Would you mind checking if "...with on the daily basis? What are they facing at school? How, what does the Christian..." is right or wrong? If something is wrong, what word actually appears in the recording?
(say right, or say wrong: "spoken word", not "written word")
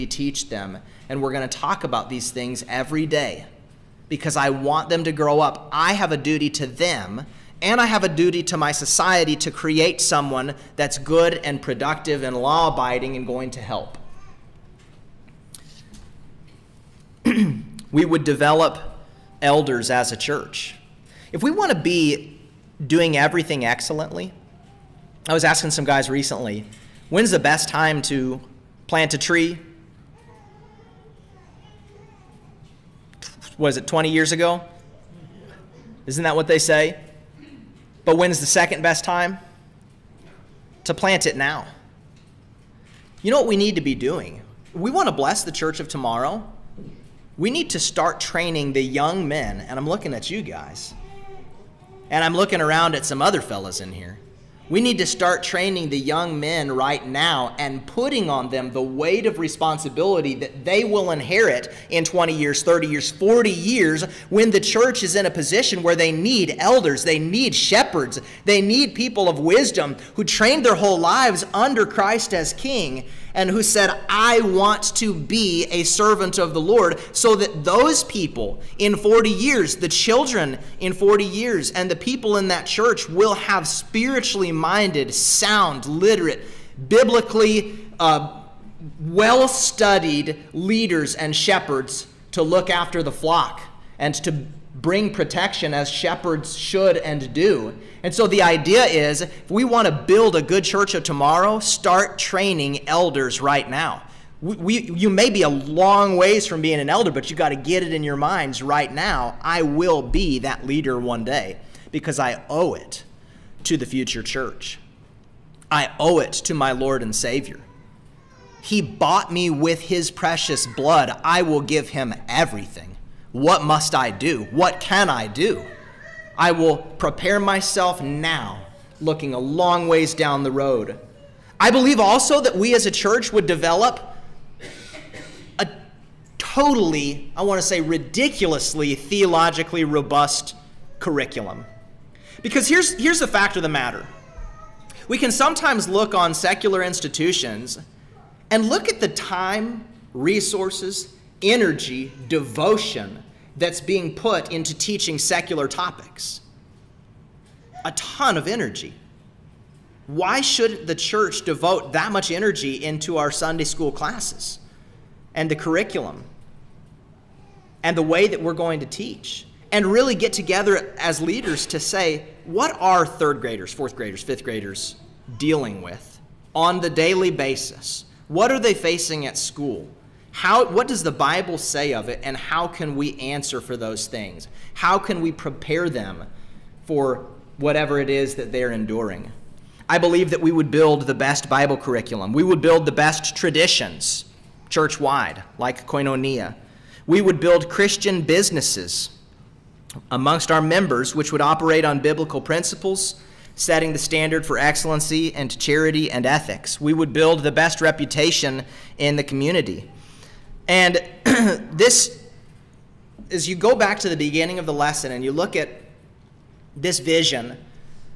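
wrong: "Bible", not "Christian".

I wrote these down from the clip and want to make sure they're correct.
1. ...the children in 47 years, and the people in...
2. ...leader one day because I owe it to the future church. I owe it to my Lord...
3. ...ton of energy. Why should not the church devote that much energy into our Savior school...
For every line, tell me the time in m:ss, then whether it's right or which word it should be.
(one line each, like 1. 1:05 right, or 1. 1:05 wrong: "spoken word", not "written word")
1. 1:19 wrong: "40", not "47"
2. 1:50 right
3. 2:37 wrong: "Sunday", not "Savior".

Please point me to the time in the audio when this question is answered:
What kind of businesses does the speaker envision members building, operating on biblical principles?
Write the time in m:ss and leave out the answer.
3:17.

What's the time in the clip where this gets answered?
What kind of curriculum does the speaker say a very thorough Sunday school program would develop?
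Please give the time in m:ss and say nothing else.
2:18.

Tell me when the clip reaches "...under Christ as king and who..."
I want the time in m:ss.
1:11.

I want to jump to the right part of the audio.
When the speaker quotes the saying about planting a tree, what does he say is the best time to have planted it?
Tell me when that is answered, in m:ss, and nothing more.
0:33.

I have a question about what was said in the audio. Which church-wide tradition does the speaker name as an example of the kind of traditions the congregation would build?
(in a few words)
Koinonia.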